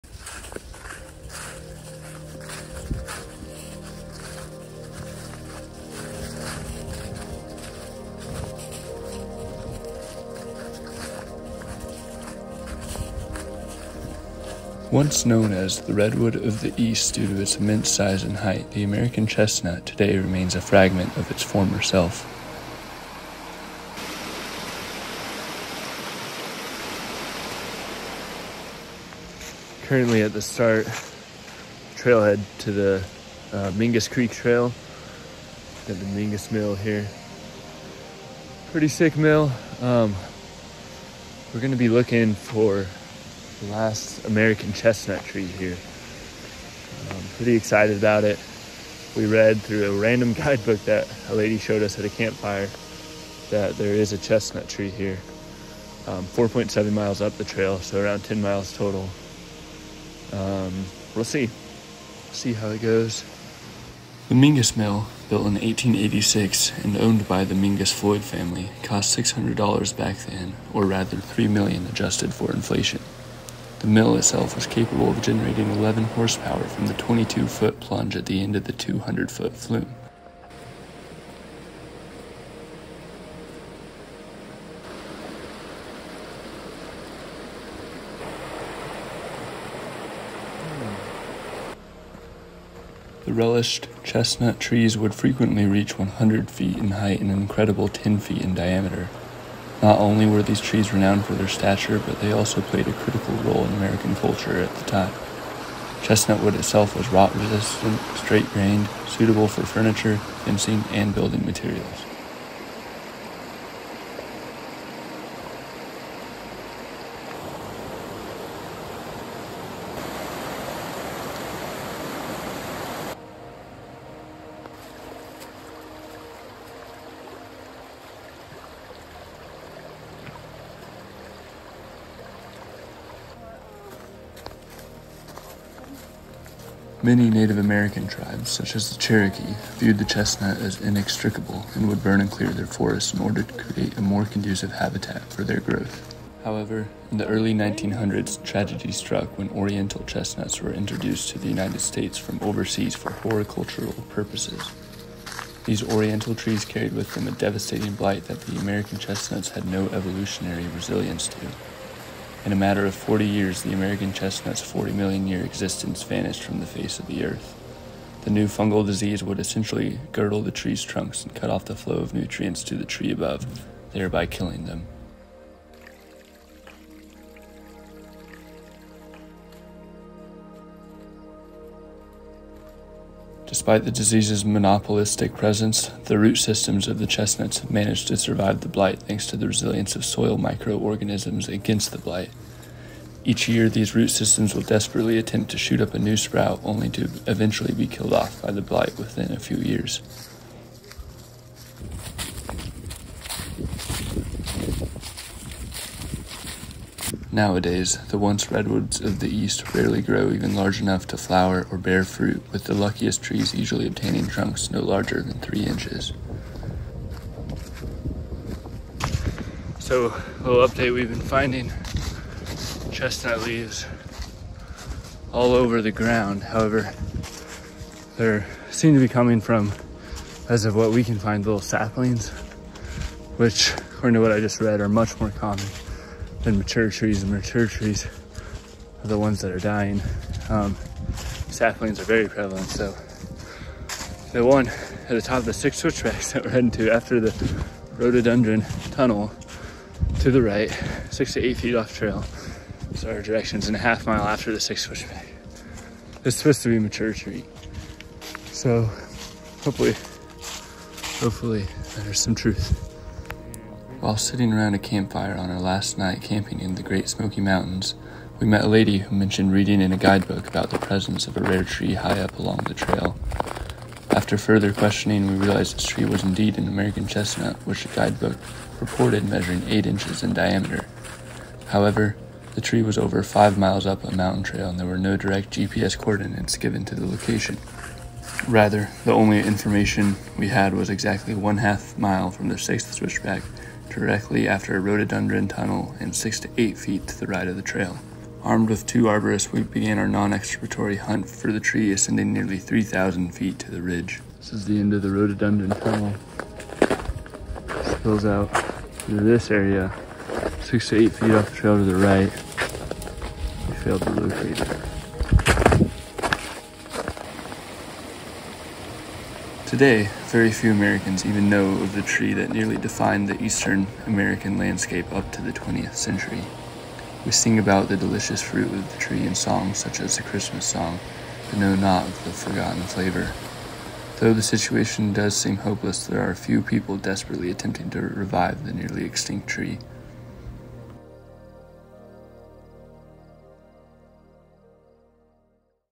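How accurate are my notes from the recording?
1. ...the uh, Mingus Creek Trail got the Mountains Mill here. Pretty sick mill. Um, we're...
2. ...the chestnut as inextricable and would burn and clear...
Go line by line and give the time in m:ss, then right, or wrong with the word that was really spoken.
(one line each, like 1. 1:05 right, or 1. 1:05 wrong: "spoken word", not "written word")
1. 0:32 wrong: "Mingus", not "Mountains"
2. 2:19 right.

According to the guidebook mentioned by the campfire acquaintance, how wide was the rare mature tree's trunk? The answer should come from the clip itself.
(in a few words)
8 inches.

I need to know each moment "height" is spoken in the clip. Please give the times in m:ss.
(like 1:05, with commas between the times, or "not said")
0:18, 1:36.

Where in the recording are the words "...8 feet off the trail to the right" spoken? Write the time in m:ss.
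5:11.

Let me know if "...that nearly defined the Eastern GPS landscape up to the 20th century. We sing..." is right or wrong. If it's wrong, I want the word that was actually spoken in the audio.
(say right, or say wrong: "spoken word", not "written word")
wrong: "American", not "GPS".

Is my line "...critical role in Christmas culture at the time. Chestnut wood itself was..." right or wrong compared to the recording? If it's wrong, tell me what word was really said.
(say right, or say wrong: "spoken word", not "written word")
wrong: "American", not "Christmas".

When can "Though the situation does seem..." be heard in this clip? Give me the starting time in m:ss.
5:34.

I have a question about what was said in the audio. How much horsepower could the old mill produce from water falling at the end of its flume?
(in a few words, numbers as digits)
11.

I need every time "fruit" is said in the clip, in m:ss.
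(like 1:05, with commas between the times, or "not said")
3:32, 5:28.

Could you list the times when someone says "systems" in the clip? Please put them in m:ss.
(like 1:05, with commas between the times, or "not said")
3:06, 3:14.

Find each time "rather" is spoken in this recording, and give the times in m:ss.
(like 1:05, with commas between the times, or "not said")
1:10, 4:48.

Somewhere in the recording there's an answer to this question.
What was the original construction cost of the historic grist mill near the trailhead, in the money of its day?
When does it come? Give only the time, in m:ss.
1:09.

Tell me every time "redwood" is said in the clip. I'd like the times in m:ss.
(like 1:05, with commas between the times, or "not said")
0:15, 3:28.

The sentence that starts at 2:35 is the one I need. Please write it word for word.
These Oriental trees carried with them a devastating blight that the American chestnuts had no evolutionary resilience to.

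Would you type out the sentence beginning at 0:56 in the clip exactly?
Um, 4.7 miles up the trail, so around 10 miles total.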